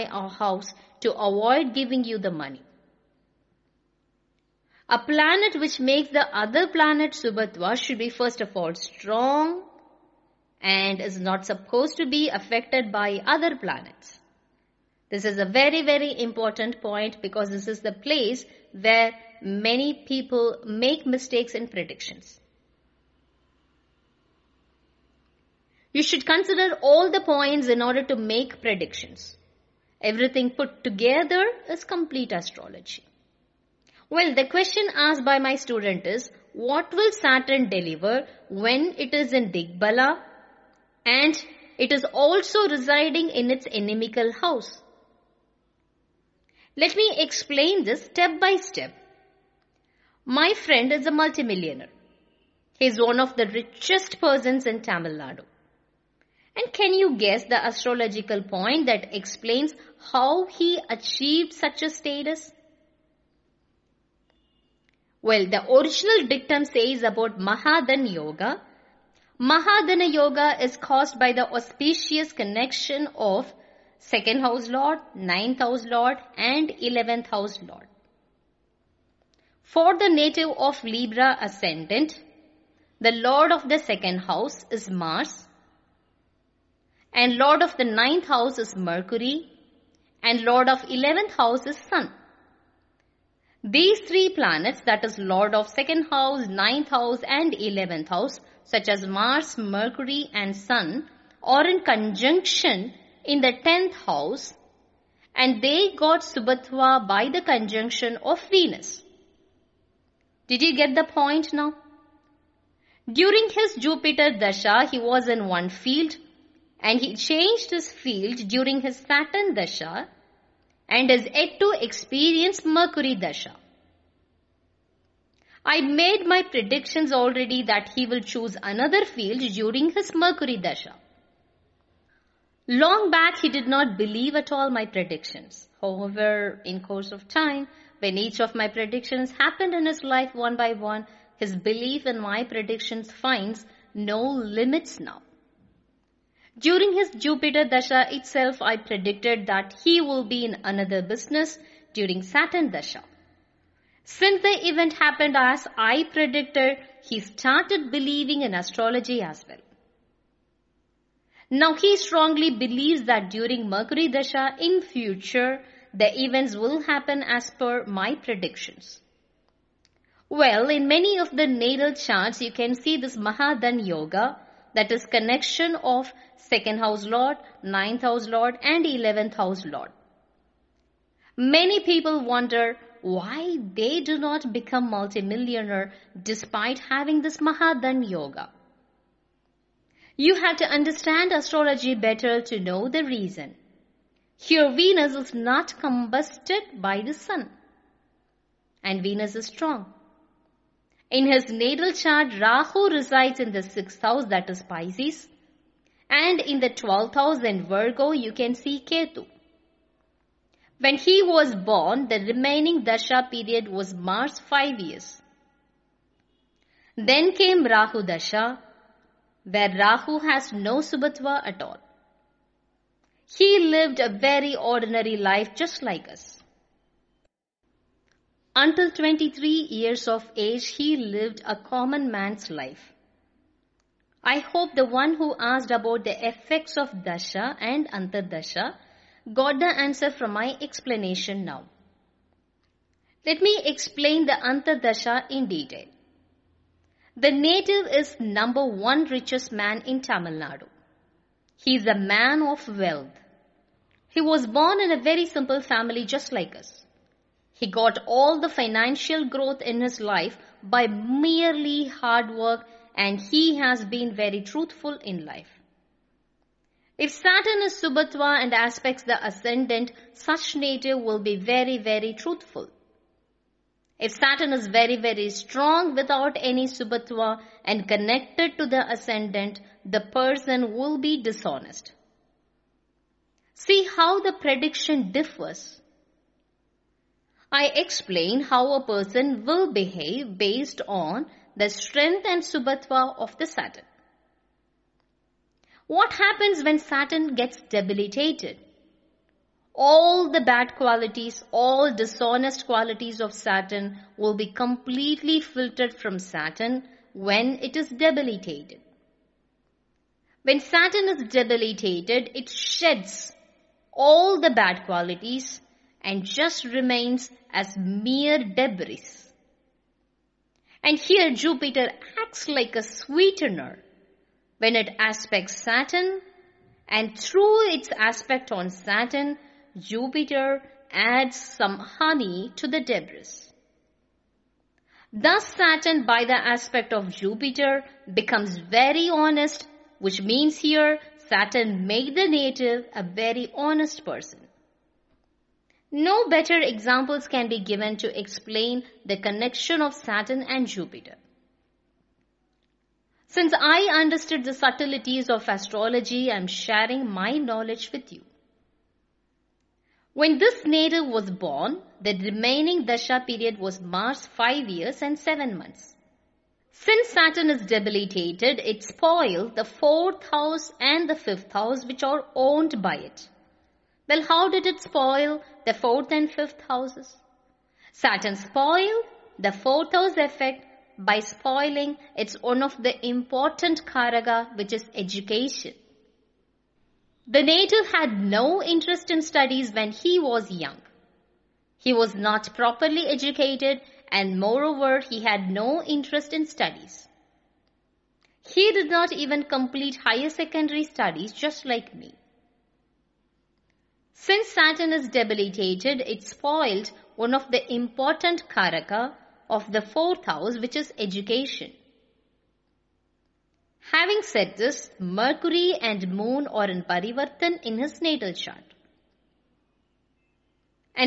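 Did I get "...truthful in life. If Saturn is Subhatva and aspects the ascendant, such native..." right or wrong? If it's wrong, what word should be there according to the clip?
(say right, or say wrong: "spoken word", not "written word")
right.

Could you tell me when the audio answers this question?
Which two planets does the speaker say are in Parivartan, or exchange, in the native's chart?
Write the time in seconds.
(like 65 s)
414 s.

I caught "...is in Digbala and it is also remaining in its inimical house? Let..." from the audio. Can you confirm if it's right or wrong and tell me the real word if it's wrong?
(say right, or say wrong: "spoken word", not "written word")
wrong: "residing", not "remaining".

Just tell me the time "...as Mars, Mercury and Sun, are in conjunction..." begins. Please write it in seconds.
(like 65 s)
98 s.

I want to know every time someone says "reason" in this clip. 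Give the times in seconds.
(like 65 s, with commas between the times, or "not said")
193 s.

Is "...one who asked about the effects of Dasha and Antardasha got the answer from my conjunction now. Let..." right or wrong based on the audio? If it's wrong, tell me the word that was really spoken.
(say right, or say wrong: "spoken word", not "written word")
wrong: "explanation", not "conjunction".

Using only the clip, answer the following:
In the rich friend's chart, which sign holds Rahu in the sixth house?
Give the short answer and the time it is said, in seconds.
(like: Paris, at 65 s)
Pisces, at 204 s.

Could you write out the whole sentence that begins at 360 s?
When this native was born, the remaining Dasha period was Mars 5 years and 7 months.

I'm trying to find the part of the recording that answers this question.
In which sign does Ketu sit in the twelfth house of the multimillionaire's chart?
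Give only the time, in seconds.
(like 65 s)
207 s.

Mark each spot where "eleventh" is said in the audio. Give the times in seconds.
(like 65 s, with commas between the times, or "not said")
76 s, 90 s, 97 s, 178 s.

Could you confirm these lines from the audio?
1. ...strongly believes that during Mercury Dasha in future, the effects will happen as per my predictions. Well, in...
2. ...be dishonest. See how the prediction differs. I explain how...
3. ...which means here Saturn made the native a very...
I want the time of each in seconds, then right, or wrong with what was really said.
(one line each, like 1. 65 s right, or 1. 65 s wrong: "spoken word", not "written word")
1. 161 s wrong: "events", not "effects"
2. 280 s right
3. 339 s right.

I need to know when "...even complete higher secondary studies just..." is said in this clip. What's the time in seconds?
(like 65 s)
399 s.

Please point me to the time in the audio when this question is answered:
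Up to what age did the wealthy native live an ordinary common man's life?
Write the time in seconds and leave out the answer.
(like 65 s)
228 s.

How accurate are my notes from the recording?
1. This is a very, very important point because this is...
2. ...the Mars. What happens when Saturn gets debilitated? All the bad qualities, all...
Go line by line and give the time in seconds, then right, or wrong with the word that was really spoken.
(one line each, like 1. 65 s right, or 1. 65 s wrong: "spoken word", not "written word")
1. 15 s right
2. 293 s wrong: "Saturn", not "Mars".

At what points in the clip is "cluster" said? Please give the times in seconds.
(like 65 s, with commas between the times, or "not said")
not said.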